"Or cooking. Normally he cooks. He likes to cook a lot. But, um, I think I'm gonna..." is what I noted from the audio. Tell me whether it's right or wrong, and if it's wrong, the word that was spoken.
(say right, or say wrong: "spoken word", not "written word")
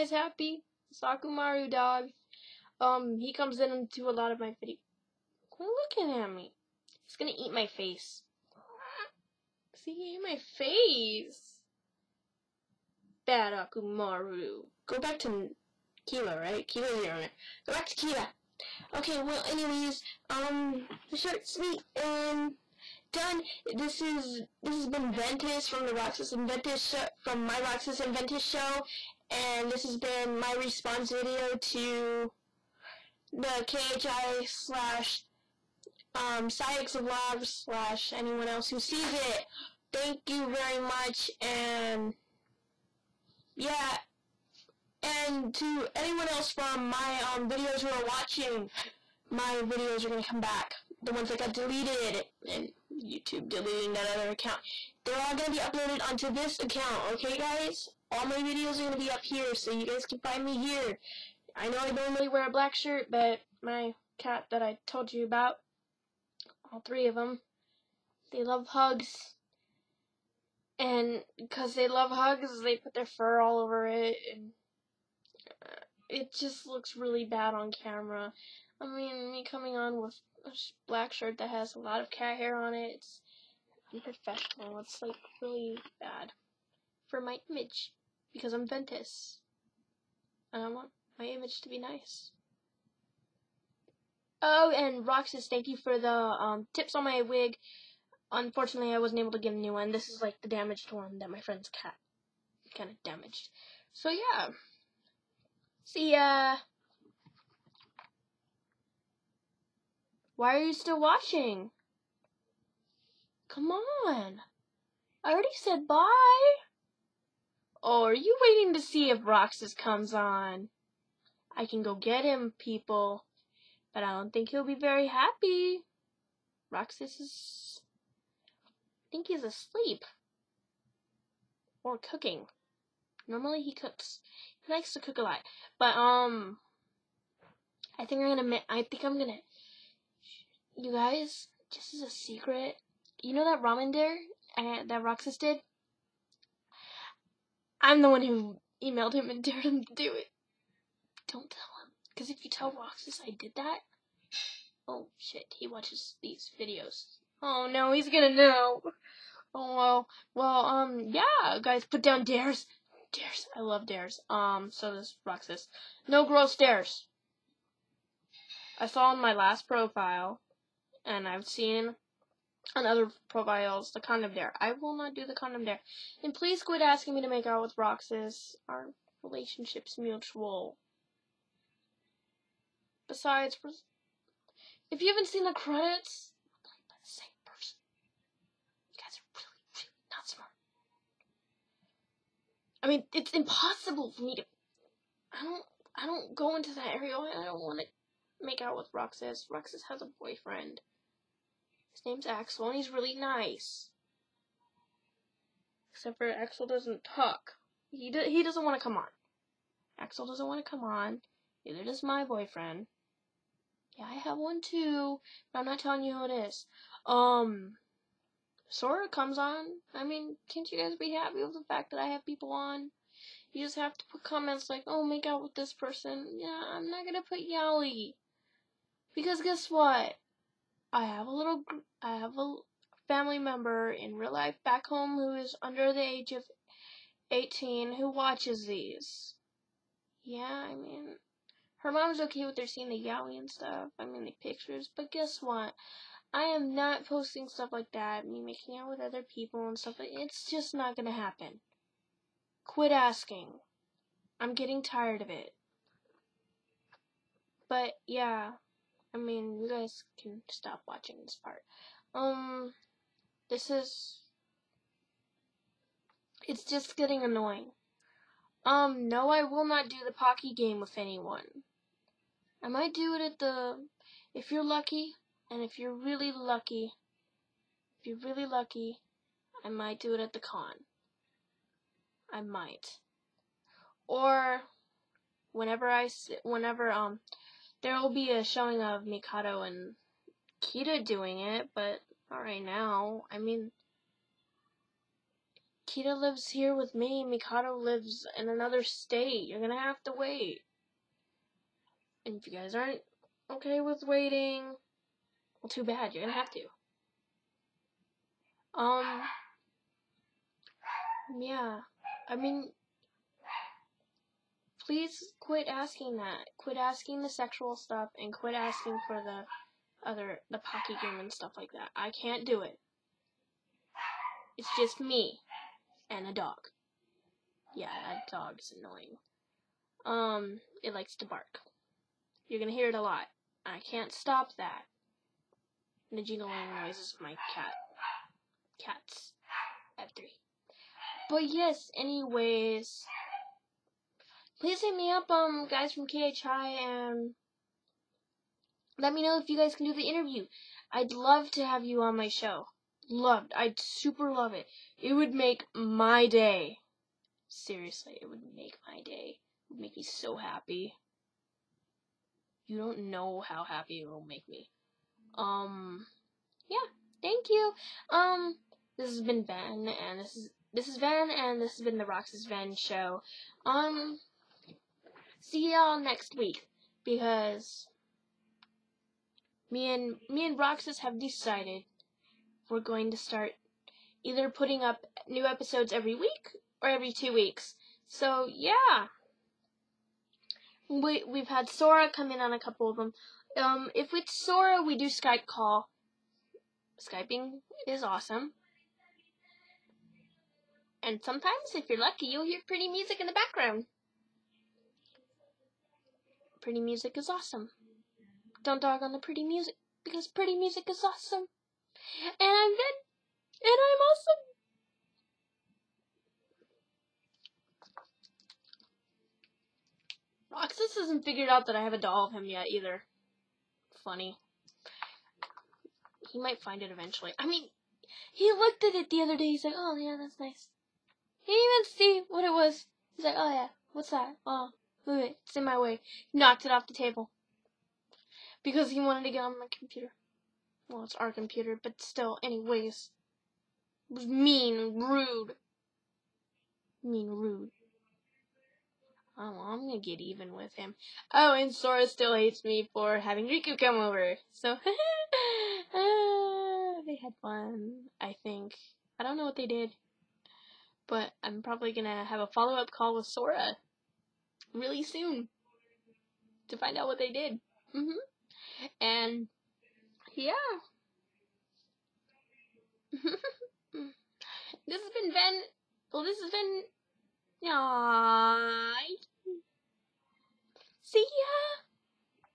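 right.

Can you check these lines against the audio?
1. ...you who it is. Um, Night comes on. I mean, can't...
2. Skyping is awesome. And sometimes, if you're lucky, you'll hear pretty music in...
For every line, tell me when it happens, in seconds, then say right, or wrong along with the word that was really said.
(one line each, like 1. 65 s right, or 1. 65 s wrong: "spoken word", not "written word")
1. 216 s wrong: "Sora", not "Night"
2. 396 s right.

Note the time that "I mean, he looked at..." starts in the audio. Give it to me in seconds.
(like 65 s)
427 s.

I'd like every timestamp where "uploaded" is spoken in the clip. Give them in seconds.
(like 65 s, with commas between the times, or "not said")
55 s.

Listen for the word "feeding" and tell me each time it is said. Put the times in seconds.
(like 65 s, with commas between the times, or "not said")
not said.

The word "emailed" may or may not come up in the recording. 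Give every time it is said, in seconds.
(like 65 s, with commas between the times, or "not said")
148 s.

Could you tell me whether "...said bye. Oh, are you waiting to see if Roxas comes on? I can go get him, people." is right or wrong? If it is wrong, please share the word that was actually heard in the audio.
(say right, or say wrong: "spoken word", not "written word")
right.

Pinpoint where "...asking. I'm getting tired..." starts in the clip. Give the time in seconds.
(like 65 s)
252 s.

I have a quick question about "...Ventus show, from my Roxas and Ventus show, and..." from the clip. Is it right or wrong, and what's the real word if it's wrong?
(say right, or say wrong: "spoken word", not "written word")
right.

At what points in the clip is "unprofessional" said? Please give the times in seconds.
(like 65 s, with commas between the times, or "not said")
83 s.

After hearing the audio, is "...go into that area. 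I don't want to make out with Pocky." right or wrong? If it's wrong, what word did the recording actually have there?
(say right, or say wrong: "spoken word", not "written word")
wrong: "Roxas", not "Pocky".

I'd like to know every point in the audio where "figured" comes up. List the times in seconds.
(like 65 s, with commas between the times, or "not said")
421 s.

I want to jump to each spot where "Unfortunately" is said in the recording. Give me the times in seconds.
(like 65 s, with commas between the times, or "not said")
98 s.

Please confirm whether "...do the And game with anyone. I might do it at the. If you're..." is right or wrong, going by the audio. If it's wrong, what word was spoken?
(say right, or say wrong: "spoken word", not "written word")
wrong: "Pocky", not "And".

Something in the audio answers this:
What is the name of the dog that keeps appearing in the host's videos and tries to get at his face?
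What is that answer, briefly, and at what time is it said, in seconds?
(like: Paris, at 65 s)
Akamaru, at 13 s.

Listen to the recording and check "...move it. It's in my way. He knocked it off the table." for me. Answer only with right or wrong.
right.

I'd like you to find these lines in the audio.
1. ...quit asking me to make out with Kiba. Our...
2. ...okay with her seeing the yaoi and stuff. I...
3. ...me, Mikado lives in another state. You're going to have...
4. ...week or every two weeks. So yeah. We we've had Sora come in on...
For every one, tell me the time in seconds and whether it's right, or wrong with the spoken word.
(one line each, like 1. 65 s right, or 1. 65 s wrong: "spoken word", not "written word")
1. 176 s wrong: "Roxas", not "Kiba"
2. 242 s right
3. 296 s right
4. 386 s right.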